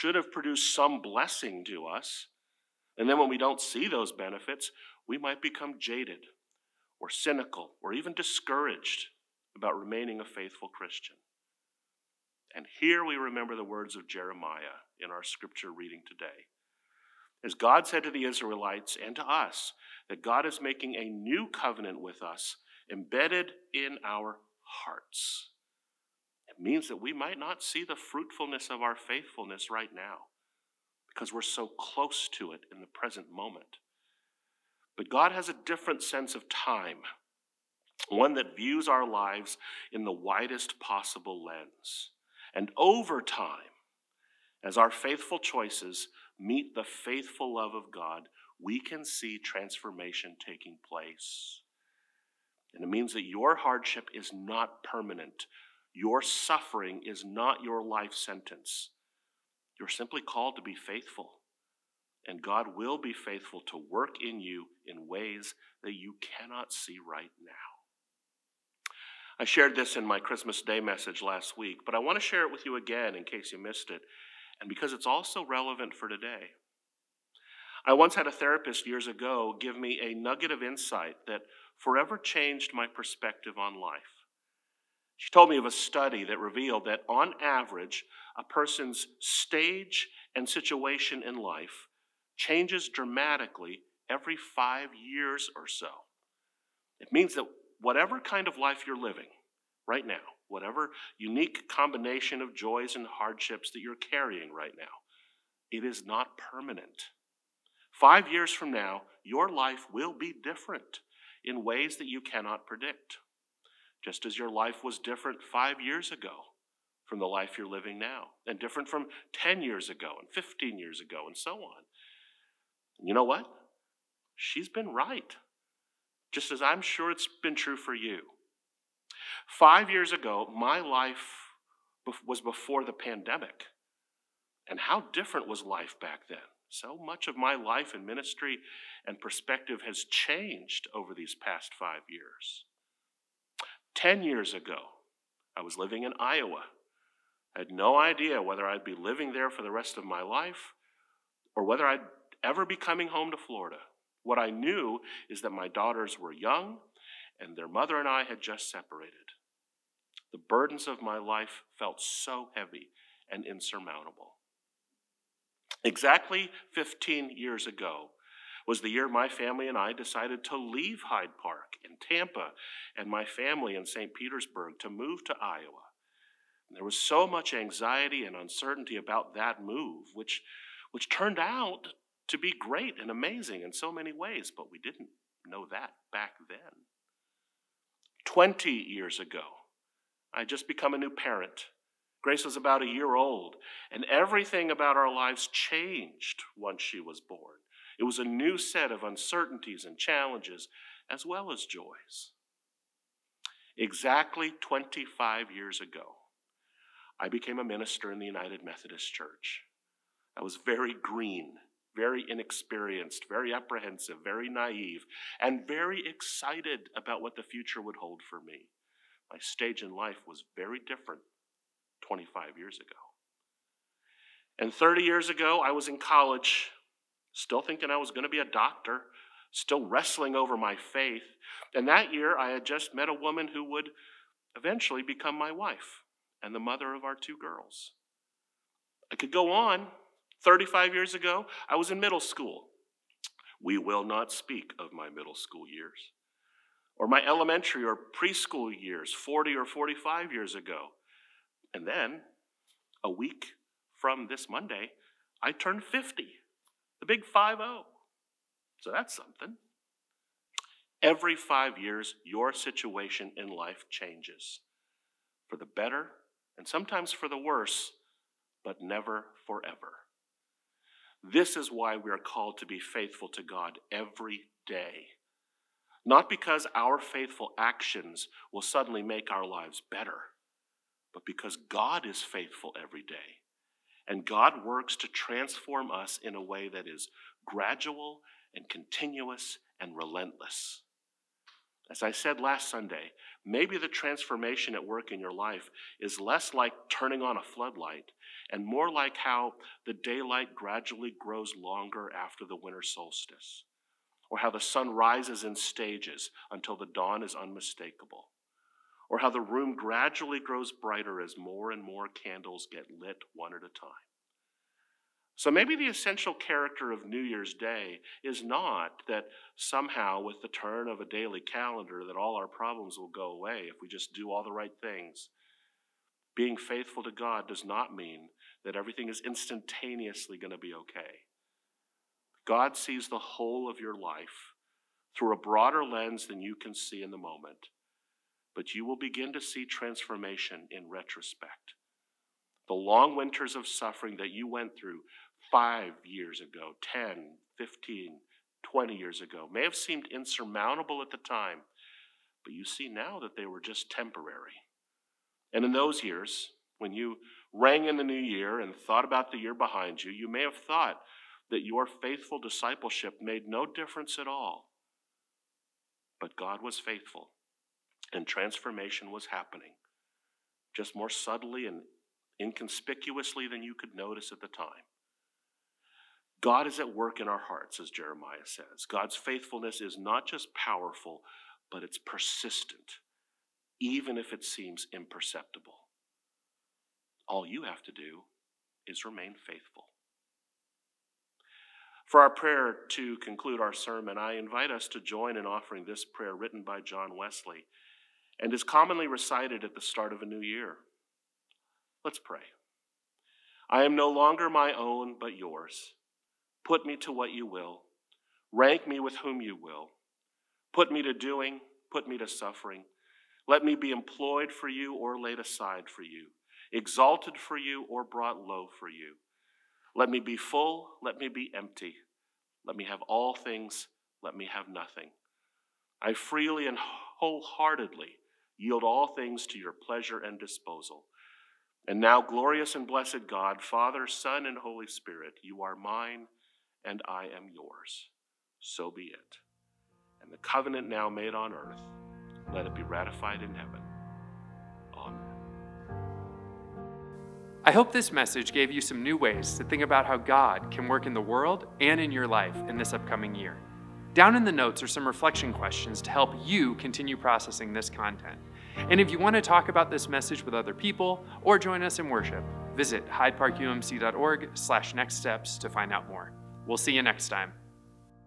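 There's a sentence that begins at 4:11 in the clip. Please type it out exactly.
And then, a week from this Monday, I turned 50, the big 5 0.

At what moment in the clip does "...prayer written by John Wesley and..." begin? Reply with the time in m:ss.
6:36.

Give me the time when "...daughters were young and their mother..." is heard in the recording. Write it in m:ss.
2:35.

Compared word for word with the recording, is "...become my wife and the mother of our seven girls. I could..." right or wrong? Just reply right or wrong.
wrong.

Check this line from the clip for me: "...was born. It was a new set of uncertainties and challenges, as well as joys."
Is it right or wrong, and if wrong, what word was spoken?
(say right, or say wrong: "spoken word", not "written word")
right.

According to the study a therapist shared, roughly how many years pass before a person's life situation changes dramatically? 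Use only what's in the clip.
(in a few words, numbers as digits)
5 years.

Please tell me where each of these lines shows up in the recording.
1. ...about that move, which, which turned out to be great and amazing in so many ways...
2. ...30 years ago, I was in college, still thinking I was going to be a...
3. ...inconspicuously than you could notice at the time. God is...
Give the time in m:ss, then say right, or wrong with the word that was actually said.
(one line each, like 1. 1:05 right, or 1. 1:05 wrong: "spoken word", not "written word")
1. 2:58 right
2. 3:44 right
3. 6:12 right.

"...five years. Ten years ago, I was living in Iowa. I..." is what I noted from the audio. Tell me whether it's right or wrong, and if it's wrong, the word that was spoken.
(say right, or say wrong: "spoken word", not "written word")
right.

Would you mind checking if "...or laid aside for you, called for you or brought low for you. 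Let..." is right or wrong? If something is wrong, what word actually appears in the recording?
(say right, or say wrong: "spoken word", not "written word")
wrong: "exalted", not "called".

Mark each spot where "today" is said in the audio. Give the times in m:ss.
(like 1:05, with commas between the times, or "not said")
0:16, 1:16.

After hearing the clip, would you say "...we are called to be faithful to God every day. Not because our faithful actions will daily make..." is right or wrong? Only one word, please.
wrong.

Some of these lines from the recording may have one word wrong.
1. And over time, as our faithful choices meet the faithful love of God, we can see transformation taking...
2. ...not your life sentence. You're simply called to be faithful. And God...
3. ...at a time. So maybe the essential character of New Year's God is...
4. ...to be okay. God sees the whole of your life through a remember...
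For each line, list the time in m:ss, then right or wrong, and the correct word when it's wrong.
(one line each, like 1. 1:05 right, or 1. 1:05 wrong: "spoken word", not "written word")
1. 0:42 right
2. 0:57 right
3. 5:13 wrong: "Day", not "God"
4. 5:30 wrong: "broader", not "remember".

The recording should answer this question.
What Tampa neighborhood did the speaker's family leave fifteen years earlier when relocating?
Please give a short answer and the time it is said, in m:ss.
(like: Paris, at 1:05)
Hyde Park, at 2:50.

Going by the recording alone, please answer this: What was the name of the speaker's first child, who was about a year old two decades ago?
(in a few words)
Grace.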